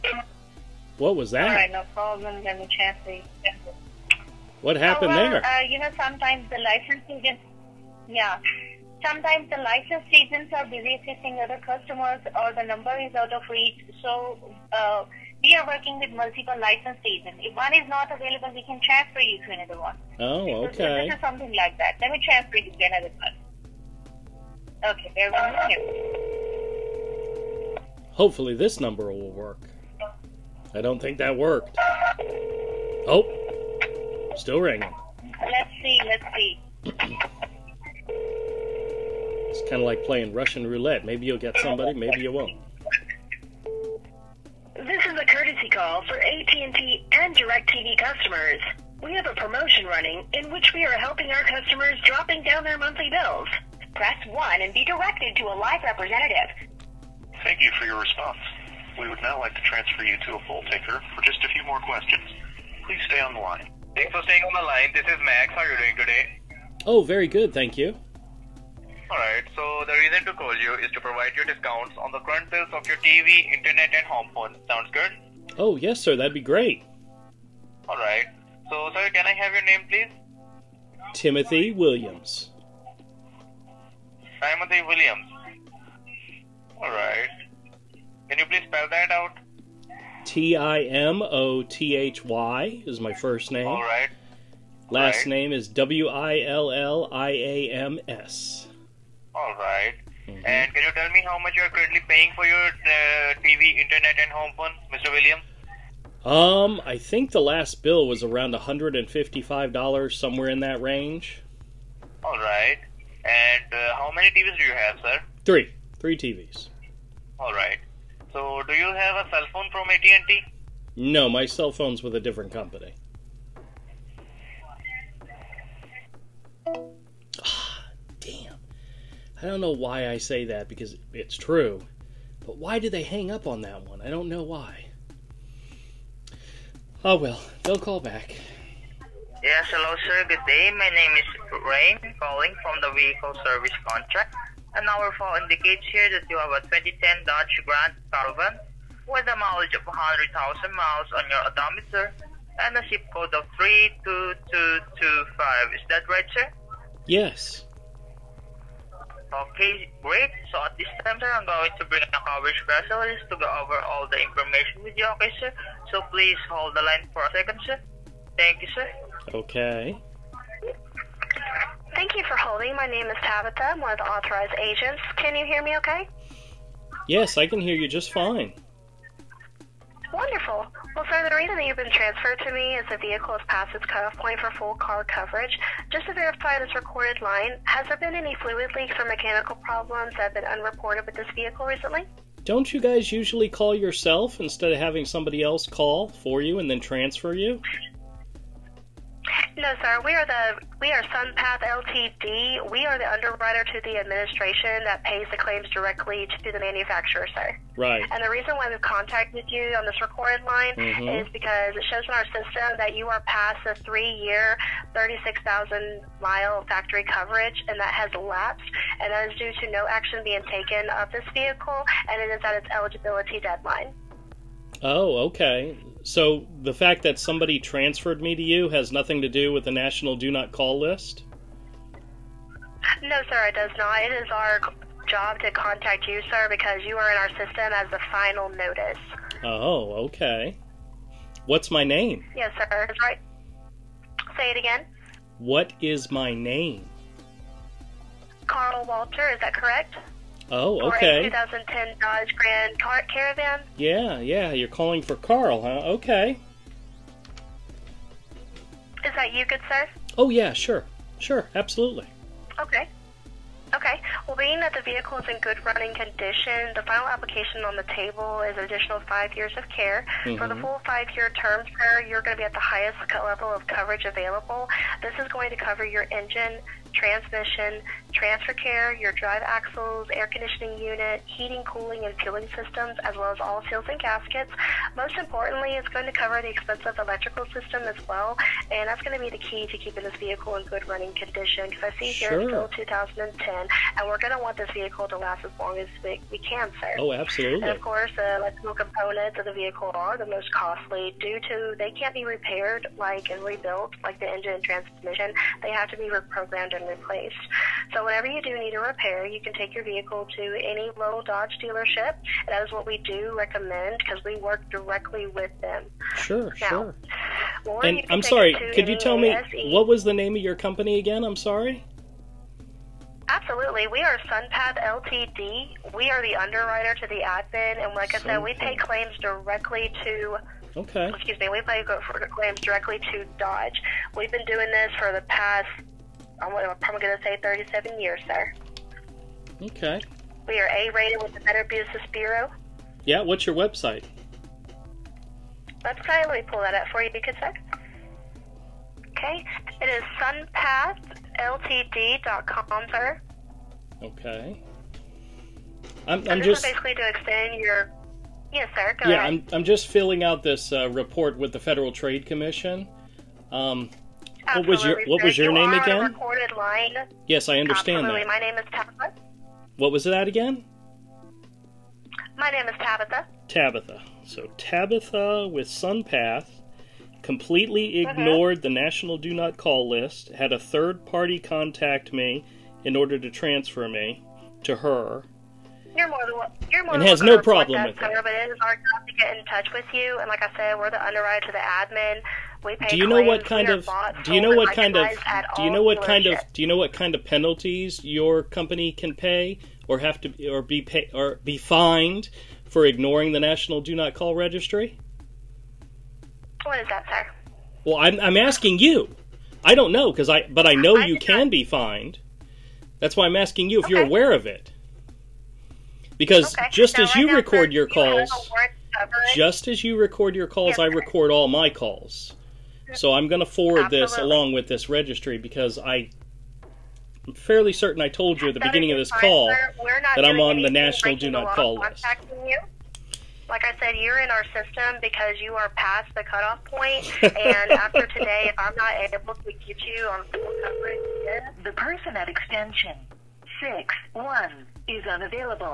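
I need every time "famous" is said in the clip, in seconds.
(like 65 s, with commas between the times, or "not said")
not said.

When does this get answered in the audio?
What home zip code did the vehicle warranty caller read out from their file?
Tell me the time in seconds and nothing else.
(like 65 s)
153 s.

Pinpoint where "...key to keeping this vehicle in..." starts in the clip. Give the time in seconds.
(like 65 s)
289 s.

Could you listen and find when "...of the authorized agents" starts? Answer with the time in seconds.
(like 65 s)
173 s.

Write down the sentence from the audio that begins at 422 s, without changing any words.
So I'm going to forward Absolutely.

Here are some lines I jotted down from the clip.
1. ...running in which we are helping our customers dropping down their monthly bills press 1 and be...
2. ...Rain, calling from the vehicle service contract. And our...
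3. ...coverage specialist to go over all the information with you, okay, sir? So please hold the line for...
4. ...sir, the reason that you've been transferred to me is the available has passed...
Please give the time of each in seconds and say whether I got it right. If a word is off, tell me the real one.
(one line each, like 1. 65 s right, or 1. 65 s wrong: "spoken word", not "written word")
1. 49 s right
2. 141 s right
3. 162 s right
4. 181 s wrong: "vehicle", not "available".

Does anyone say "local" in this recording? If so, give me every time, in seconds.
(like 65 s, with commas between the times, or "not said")
310 s.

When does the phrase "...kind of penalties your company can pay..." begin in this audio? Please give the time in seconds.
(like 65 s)
396 s.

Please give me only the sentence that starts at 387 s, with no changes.
But it is our job to get in touch with you, and like I said, we're the underwriter to the admin.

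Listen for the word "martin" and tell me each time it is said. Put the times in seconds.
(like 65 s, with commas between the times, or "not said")
not said.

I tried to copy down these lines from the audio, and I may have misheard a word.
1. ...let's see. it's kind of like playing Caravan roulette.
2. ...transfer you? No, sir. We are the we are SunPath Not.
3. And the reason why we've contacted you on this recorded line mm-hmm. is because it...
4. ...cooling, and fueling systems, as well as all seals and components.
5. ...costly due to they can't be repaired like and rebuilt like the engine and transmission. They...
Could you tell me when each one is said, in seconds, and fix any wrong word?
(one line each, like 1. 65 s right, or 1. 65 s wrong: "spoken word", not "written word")
1. 36 s wrong: "Russian", not "Caravan"
2. 196 s wrong: "Ltd", not "Not"
3. 208 s right
4. 281 s wrong: "gaskets", not "components"
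5. 300 s right.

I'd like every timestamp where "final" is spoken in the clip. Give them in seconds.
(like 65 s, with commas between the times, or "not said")
238 s, 266 s.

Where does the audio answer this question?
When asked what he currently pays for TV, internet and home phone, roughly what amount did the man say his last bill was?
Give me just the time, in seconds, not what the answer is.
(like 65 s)
108 s.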